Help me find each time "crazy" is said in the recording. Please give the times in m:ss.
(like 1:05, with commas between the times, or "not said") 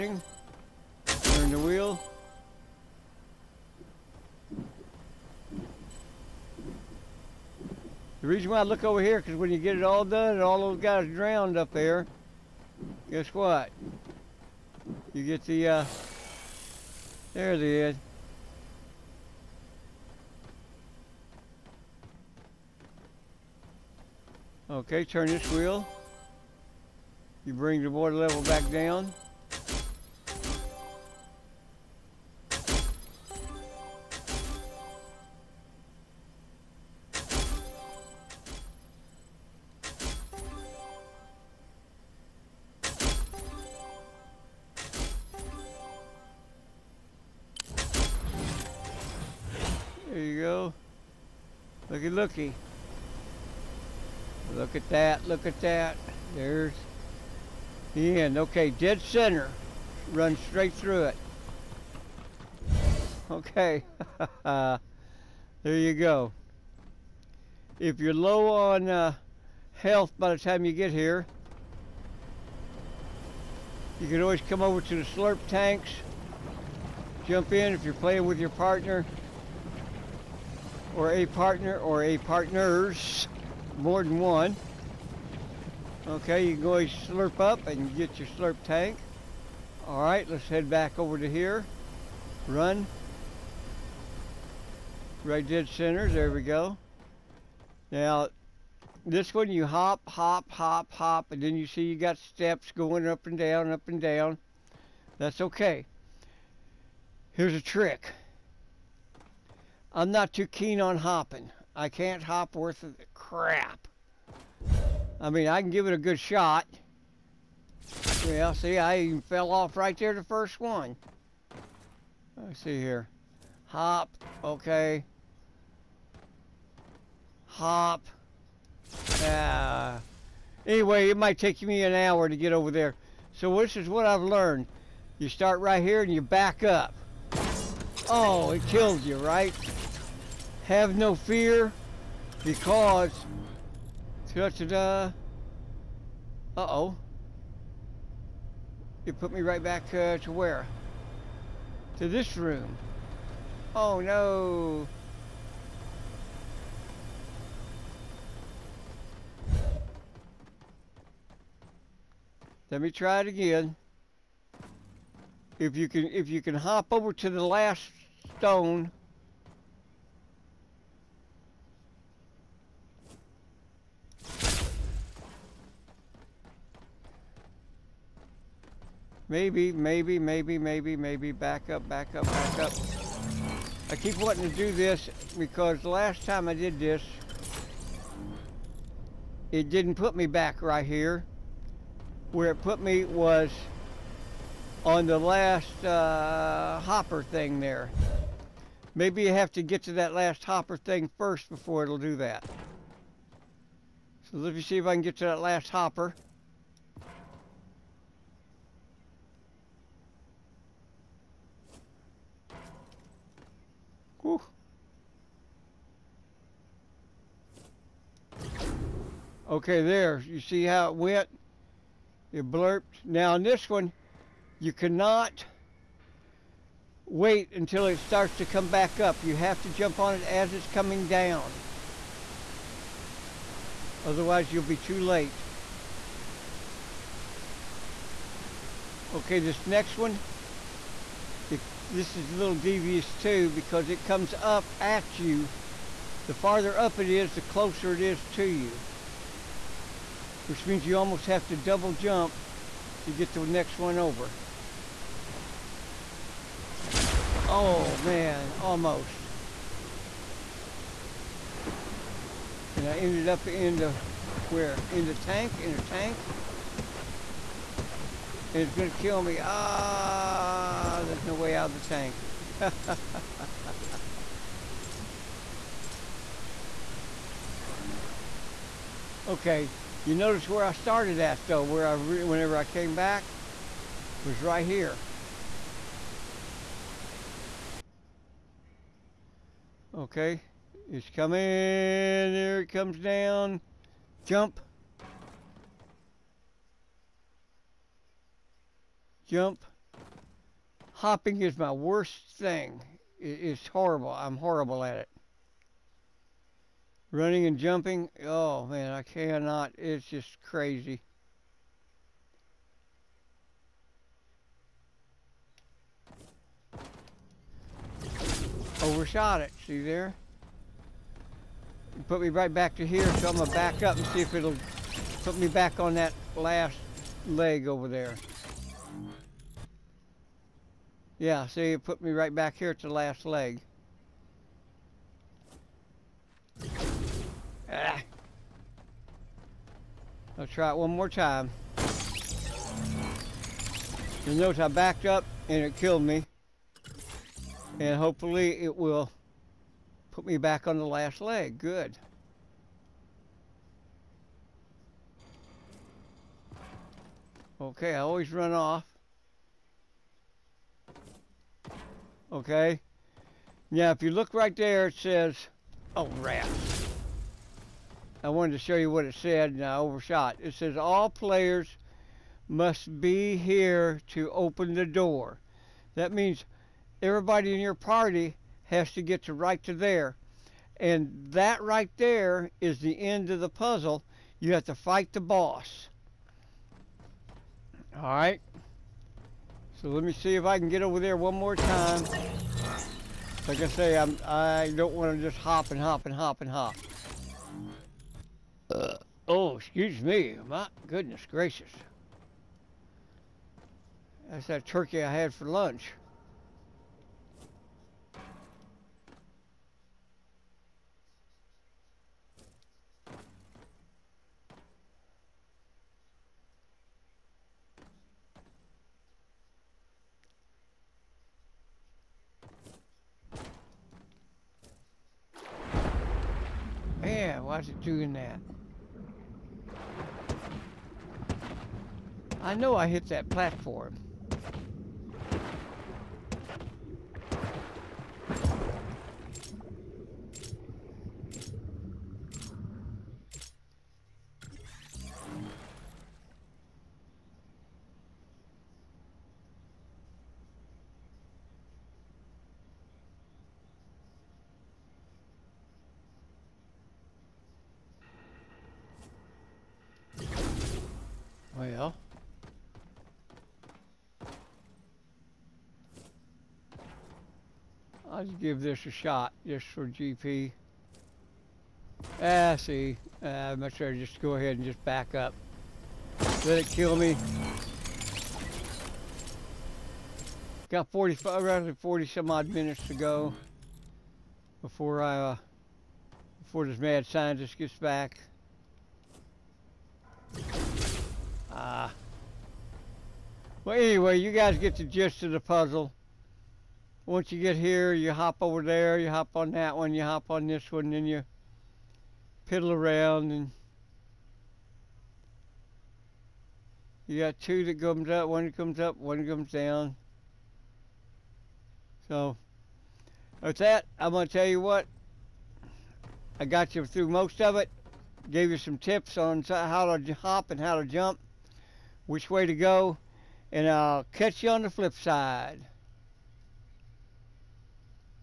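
5:10.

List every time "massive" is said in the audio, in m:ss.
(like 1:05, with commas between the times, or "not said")
not said.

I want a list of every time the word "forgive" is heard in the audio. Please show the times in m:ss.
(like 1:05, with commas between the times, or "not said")
not said.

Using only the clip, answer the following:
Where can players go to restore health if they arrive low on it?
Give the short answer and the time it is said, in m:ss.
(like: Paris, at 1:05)
Slurp tanks, at 1:15.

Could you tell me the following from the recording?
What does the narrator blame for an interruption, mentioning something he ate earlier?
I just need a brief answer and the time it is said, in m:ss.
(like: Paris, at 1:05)
Turkey, at 6:44.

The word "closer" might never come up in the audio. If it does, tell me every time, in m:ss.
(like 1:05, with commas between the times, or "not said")
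4:07.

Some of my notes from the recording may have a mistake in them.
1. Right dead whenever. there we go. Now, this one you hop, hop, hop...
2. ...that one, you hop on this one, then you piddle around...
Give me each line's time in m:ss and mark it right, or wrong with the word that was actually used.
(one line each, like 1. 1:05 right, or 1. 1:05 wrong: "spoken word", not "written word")
1. 1:35 wrong: "center", not "whenever"
2. 8:19 right.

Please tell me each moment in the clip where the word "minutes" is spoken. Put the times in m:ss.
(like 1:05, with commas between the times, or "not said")
8:02.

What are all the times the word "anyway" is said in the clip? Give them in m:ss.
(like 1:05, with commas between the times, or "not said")
2:10, 8:13.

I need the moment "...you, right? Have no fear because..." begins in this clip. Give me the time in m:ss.
2:19.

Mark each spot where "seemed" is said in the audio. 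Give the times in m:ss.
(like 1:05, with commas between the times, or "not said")
not said.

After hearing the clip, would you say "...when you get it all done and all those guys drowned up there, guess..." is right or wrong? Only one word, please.
right.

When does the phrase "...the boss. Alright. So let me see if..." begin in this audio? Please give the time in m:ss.
6:25.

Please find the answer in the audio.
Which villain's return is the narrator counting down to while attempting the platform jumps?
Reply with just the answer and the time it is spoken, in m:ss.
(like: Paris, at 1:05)
Mad scientist, at 8:06.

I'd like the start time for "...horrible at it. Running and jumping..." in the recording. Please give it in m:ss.
5:04.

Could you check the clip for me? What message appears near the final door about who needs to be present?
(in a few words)
All players must be here.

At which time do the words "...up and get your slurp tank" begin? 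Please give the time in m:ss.
1:27.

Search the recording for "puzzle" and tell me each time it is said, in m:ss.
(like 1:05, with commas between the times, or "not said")
6:23, 8:15.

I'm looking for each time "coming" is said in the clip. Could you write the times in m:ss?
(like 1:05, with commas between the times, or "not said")
3:50, 4:51.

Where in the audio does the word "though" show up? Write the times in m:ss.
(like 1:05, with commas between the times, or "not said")
4:41.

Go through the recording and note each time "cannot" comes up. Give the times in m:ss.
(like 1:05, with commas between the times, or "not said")
3:44, 5:09.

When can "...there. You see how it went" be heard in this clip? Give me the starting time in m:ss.
3:39.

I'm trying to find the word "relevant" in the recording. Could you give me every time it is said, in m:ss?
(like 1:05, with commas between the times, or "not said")
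not said.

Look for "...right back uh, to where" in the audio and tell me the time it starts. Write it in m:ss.
2:29.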